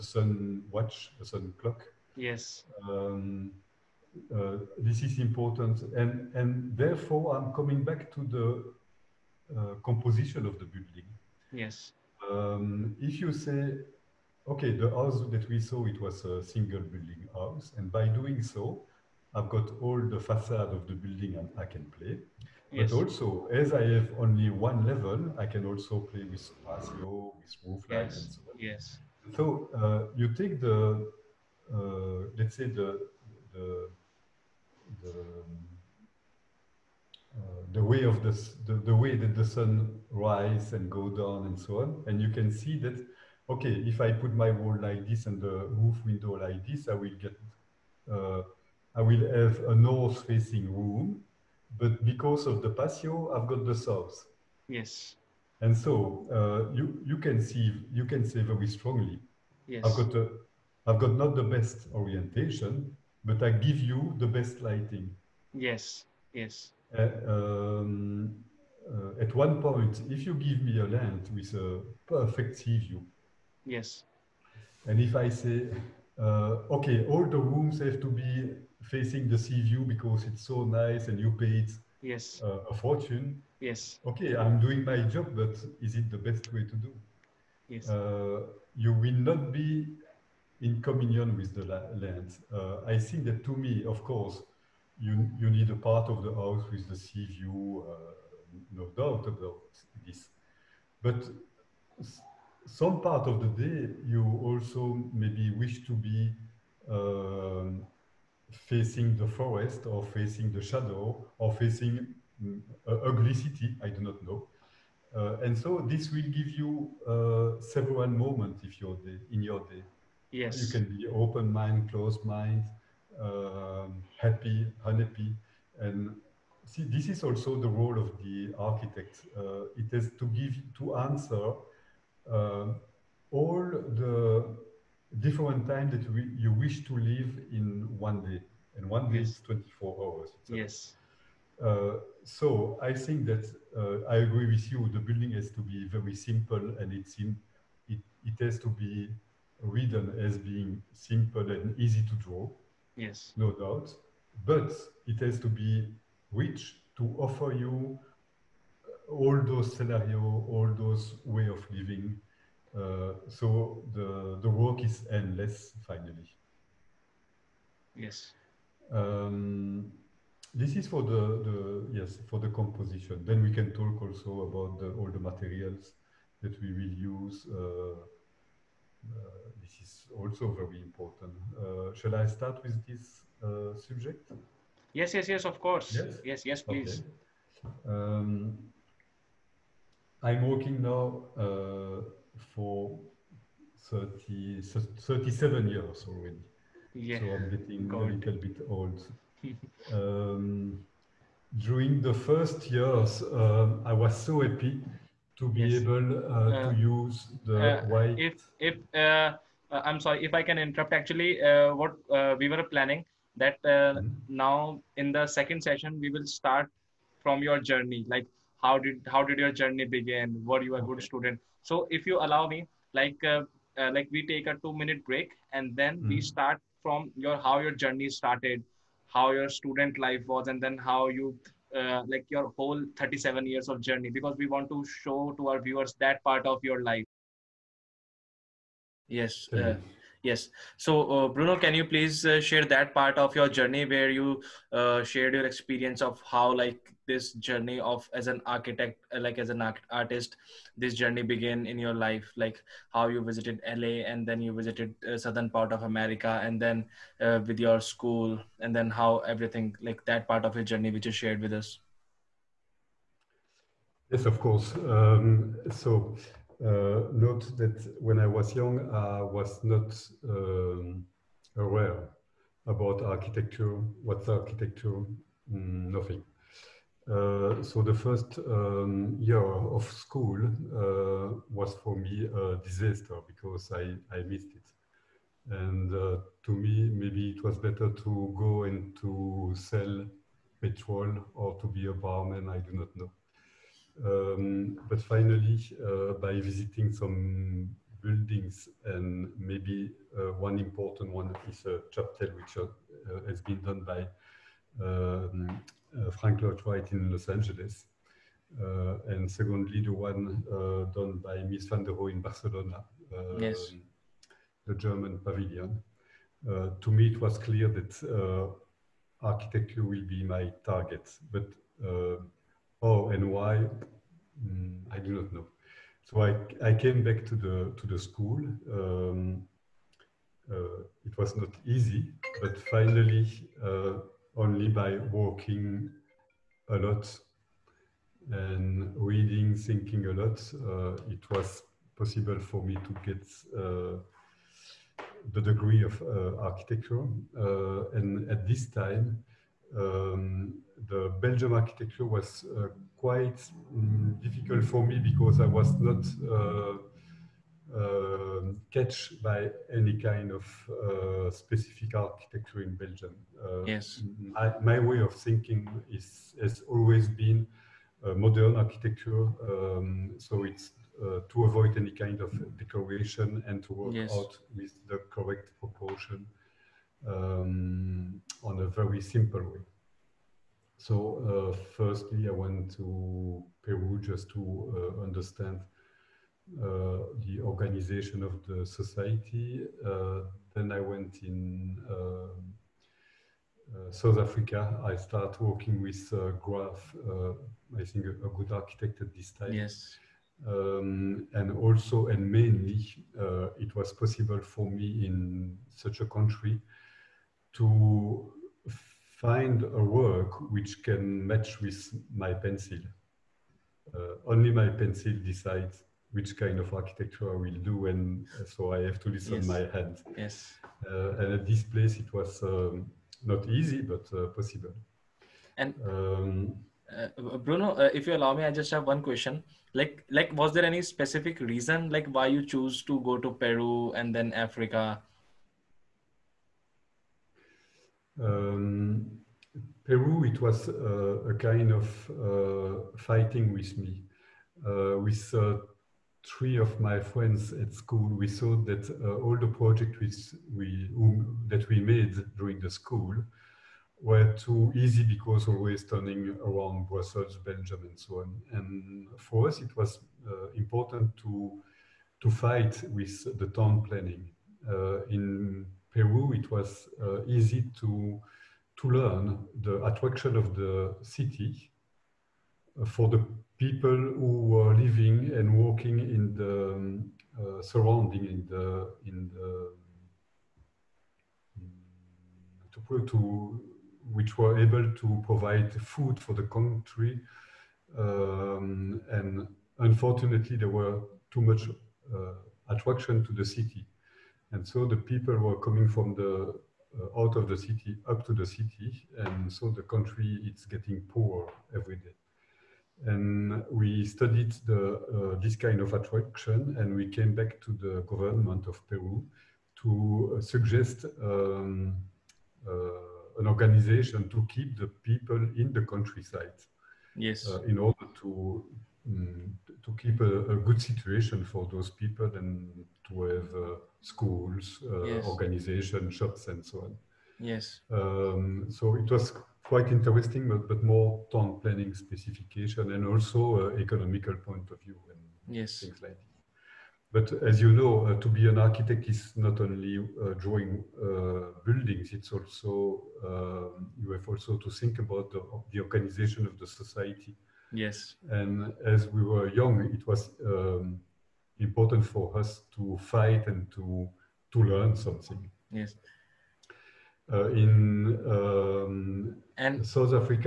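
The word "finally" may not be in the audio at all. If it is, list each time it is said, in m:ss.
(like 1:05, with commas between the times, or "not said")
2:45, 4:55, 5:32.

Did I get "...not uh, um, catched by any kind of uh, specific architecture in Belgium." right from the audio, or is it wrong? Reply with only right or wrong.
right.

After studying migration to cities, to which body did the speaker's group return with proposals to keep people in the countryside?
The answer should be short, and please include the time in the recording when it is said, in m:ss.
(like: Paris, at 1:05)
government of Peru, at 8:28.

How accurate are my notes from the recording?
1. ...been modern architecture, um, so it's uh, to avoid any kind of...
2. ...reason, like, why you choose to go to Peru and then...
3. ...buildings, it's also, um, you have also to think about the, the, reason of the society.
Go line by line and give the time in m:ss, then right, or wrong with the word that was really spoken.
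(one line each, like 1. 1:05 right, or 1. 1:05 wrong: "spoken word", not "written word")
1. 6:07 right
2. 7:11 right
3. 9:01 wrong: "organization", not "reason".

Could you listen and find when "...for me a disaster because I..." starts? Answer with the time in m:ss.
4:41.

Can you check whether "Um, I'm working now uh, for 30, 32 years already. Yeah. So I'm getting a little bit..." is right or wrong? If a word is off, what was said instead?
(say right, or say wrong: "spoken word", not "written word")
wrong: "37", not "32".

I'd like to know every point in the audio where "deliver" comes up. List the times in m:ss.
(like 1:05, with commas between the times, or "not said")
not said.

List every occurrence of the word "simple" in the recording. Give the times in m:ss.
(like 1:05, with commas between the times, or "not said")
2:26, 2:30, 6:19.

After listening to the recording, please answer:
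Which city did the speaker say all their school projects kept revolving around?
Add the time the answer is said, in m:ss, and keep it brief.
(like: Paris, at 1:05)
Brussels, at 7:36.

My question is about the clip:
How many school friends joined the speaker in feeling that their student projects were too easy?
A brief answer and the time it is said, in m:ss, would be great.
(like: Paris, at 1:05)
3, at 7:26.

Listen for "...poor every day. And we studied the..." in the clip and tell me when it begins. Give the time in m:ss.
8:21.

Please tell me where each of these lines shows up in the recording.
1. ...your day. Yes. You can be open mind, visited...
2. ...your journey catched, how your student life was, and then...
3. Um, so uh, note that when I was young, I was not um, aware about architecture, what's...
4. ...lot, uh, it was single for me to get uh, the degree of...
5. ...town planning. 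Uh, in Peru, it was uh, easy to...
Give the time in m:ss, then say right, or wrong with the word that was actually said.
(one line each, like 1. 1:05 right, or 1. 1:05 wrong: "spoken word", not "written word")
1. 1:59 wrong: "closed", not "visited"
2. 3:47 wrong: "started", not "catched"
3. 4:24 right
4. 5:40 wrong: "possible", not "single"
5. 7:43 right.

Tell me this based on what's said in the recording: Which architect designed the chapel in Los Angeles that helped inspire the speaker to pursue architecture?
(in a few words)
Frank Lloyd Wright.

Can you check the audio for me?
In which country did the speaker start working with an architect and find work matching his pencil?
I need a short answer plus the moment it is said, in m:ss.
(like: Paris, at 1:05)
South Africa, at 6:33.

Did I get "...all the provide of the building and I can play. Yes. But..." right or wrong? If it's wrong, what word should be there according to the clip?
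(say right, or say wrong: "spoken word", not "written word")
wrong: "facade", not "provide".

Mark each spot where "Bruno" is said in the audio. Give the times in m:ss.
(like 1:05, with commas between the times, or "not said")
4:01, 7:07.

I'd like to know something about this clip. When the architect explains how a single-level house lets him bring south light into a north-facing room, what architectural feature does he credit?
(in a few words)
patio.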